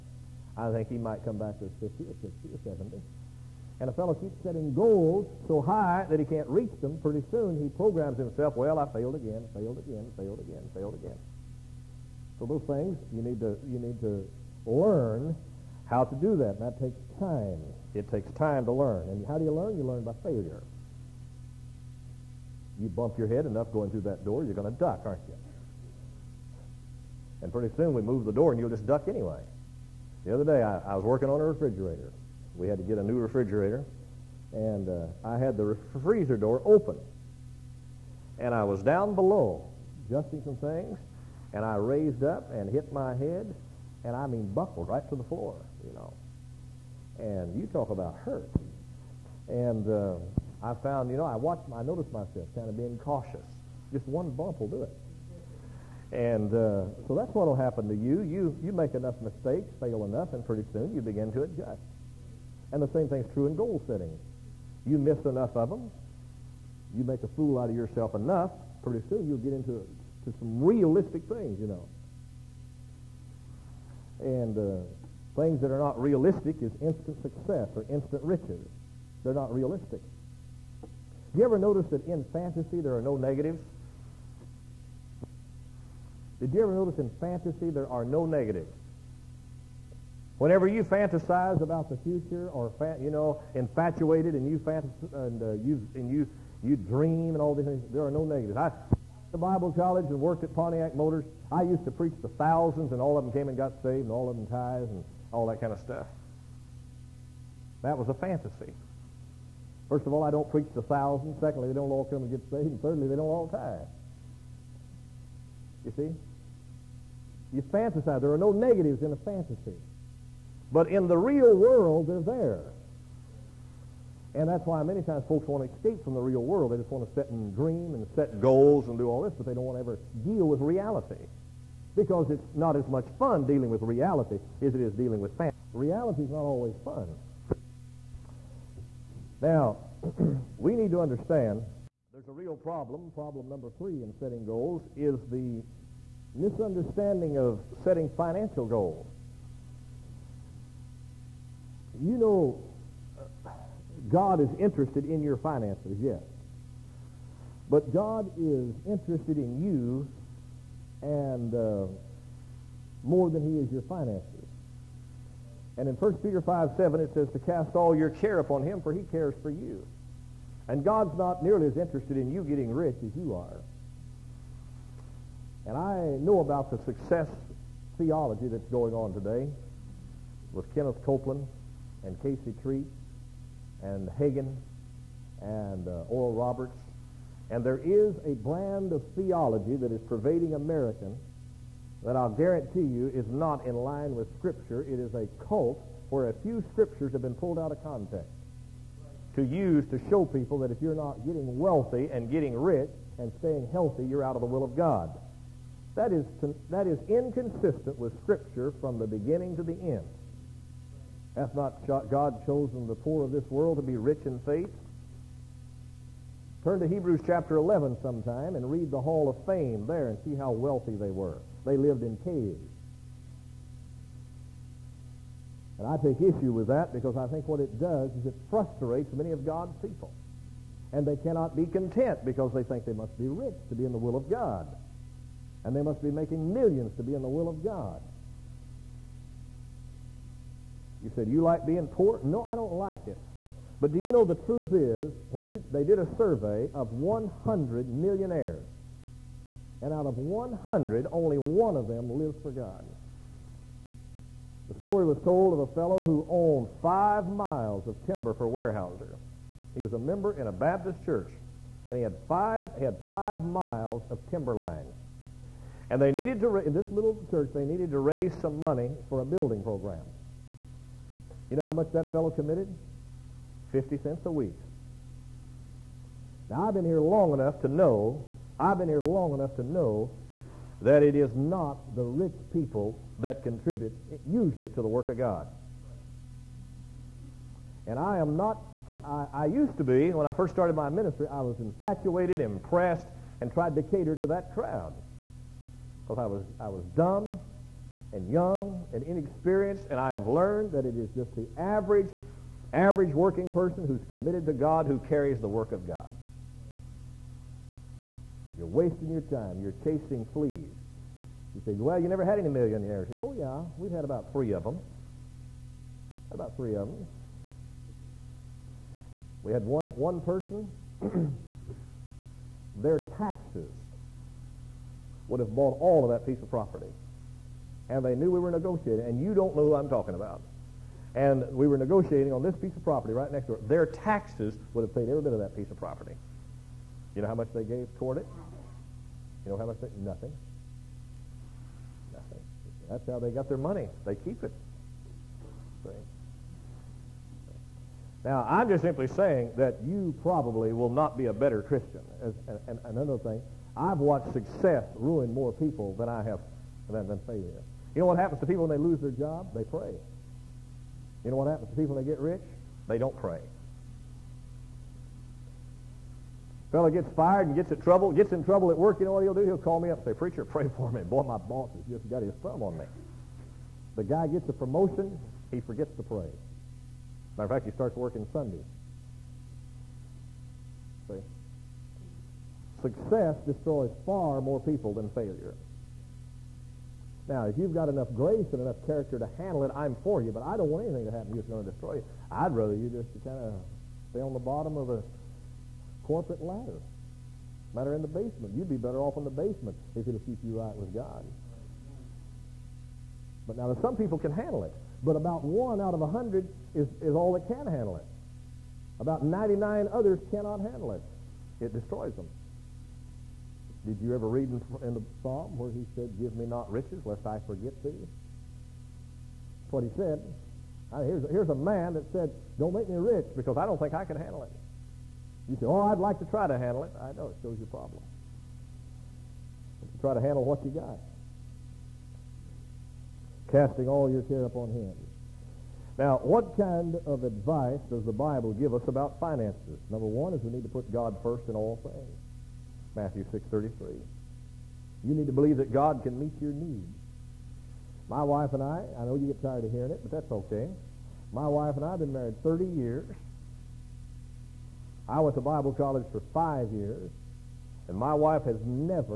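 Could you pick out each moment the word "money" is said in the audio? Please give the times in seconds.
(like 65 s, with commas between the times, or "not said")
268 s, 343 s.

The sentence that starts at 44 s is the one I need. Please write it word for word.
And I mean buckled right to the floor, you know.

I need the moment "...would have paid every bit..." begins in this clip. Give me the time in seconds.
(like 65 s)
334 s.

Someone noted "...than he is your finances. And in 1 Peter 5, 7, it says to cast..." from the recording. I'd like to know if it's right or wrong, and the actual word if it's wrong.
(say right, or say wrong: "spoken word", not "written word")
right.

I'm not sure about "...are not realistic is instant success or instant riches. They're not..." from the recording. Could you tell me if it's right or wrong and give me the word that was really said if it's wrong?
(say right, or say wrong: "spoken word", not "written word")
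right.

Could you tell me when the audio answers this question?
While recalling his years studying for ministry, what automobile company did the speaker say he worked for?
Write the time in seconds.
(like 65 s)
100 s.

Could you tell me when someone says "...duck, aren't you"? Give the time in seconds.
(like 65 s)
24 s.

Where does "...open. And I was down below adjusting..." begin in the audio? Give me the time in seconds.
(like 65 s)
36 s.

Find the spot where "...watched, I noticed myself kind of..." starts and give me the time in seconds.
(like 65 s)
51 s.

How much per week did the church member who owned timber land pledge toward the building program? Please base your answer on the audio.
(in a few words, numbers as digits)
50 cents.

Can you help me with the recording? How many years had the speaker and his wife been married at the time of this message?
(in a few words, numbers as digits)
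30.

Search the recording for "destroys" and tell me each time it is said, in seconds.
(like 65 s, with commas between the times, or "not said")
383 s, 391 s, 411 s.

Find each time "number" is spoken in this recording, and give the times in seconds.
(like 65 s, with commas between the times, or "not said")
143 s, 439 s.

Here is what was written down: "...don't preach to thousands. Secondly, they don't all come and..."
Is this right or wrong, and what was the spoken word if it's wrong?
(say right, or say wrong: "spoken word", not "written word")
right.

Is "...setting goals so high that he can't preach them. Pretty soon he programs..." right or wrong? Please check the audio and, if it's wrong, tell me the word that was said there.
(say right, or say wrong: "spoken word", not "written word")
wrong: "reach", not "preach".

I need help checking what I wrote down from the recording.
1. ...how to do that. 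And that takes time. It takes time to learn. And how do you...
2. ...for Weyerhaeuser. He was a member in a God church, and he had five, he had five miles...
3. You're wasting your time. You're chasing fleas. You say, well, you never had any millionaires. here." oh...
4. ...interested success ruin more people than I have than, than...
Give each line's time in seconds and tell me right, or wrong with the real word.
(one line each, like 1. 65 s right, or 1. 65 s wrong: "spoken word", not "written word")
1. 15 s right
2. 258 s wrong: "Baptist", not "God"
3. 308 s right
4. 353 s wrong: "watched", not "interested".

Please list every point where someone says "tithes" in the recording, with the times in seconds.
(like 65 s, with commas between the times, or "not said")
104 s, 113 s.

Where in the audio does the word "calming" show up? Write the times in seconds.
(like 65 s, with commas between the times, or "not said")
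not said.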